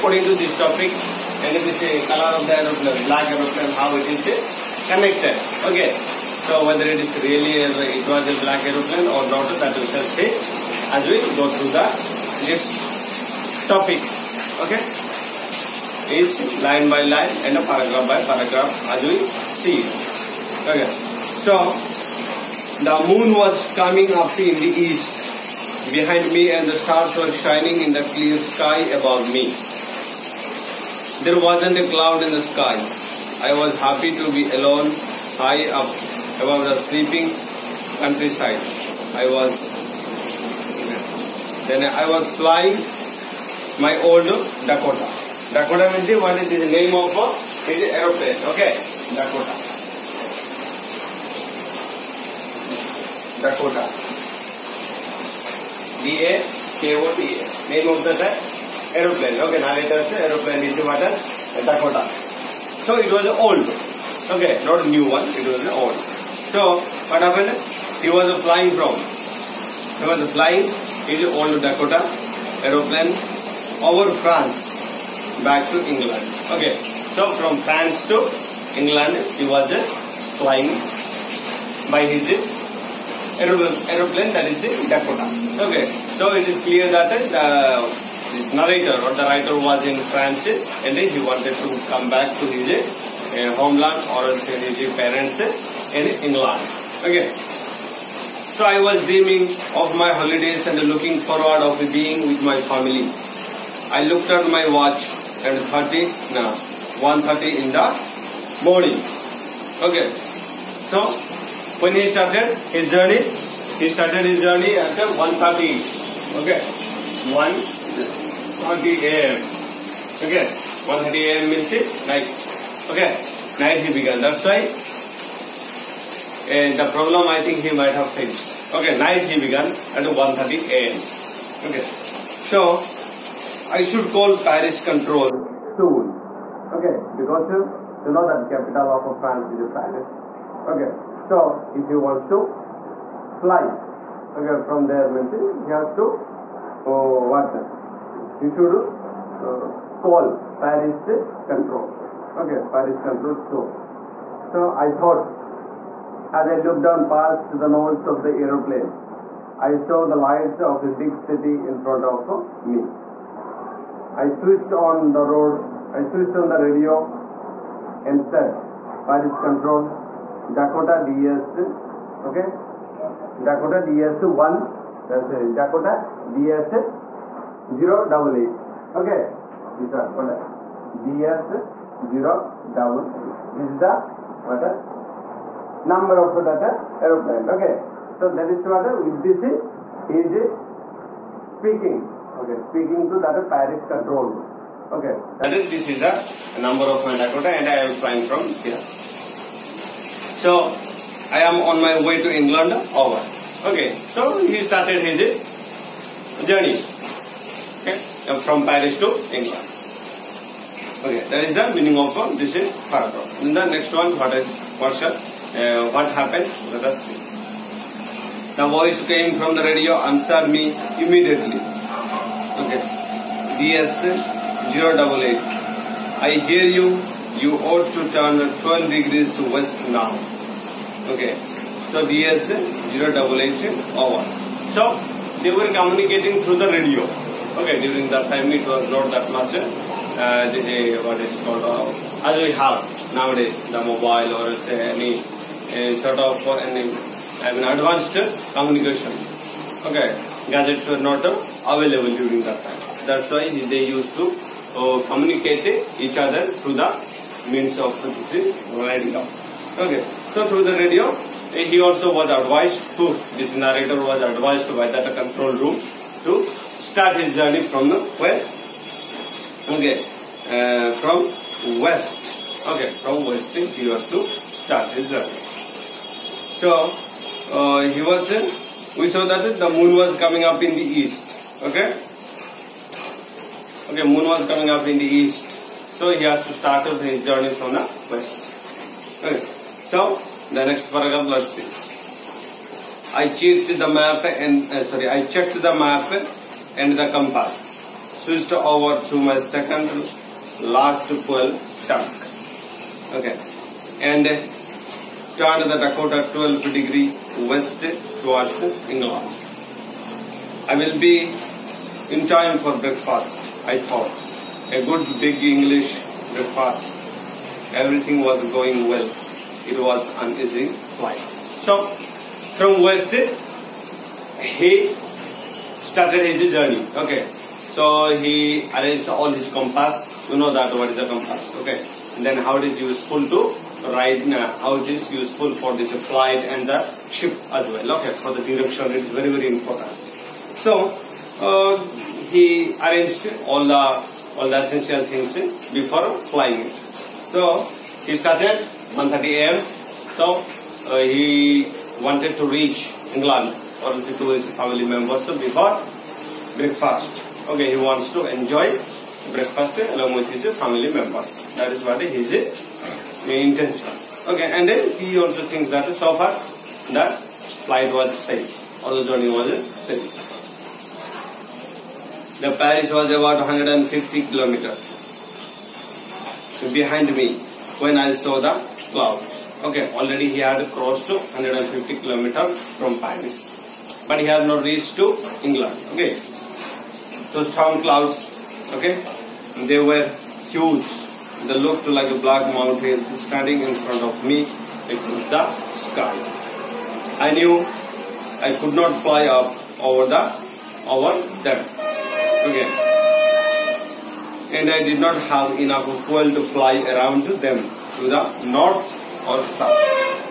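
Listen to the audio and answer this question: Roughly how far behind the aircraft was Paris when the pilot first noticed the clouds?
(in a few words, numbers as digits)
150 kilometers.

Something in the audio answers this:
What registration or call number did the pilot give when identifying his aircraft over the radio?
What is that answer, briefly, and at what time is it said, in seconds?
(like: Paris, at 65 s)
DS 088, at 175 s.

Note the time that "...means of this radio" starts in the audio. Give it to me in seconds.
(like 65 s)
257 s.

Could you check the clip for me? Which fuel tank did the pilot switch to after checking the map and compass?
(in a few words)
second last fuel tank.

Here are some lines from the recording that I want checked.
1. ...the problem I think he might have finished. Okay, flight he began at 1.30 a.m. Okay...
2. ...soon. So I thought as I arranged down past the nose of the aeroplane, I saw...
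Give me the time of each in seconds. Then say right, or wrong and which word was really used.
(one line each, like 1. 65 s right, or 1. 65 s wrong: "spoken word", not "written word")
1. 126 s wrong: "night", not "flight"
2. 153 s wrong: "looked", not "arranged".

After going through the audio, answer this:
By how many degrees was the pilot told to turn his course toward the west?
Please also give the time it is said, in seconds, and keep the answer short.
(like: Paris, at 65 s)
12, at 227 s.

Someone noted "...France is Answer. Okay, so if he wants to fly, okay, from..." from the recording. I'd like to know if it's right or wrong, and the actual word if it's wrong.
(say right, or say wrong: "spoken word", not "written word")
wrong: "Paris", not "Answer".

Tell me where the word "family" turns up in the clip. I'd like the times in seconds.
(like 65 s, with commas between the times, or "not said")
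102 s, 354 s, 360 s.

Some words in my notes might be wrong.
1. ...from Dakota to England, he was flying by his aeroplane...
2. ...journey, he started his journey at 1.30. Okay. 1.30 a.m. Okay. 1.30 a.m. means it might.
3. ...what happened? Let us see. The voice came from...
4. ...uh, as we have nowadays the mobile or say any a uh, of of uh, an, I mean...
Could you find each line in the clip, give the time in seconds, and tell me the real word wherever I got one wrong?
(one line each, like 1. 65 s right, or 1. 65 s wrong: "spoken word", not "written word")
1. 77 s wrong: "France", not "Dakota"
2. 112 s wrong: "night", not "might"
3. 215 s right
4. 241 s right.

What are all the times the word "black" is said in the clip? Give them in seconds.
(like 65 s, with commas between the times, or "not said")
3 s, 8 s, 392 s.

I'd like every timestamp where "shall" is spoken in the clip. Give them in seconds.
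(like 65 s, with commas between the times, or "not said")
9 s, 214 s.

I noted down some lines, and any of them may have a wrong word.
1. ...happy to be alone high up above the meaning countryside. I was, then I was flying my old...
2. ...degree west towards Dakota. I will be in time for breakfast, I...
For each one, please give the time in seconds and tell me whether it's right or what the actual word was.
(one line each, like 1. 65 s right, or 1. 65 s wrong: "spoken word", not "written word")
1. 33 s wrong: "sleeping", not "meaning"
2. 306 s wrong: "England", not "Dakota".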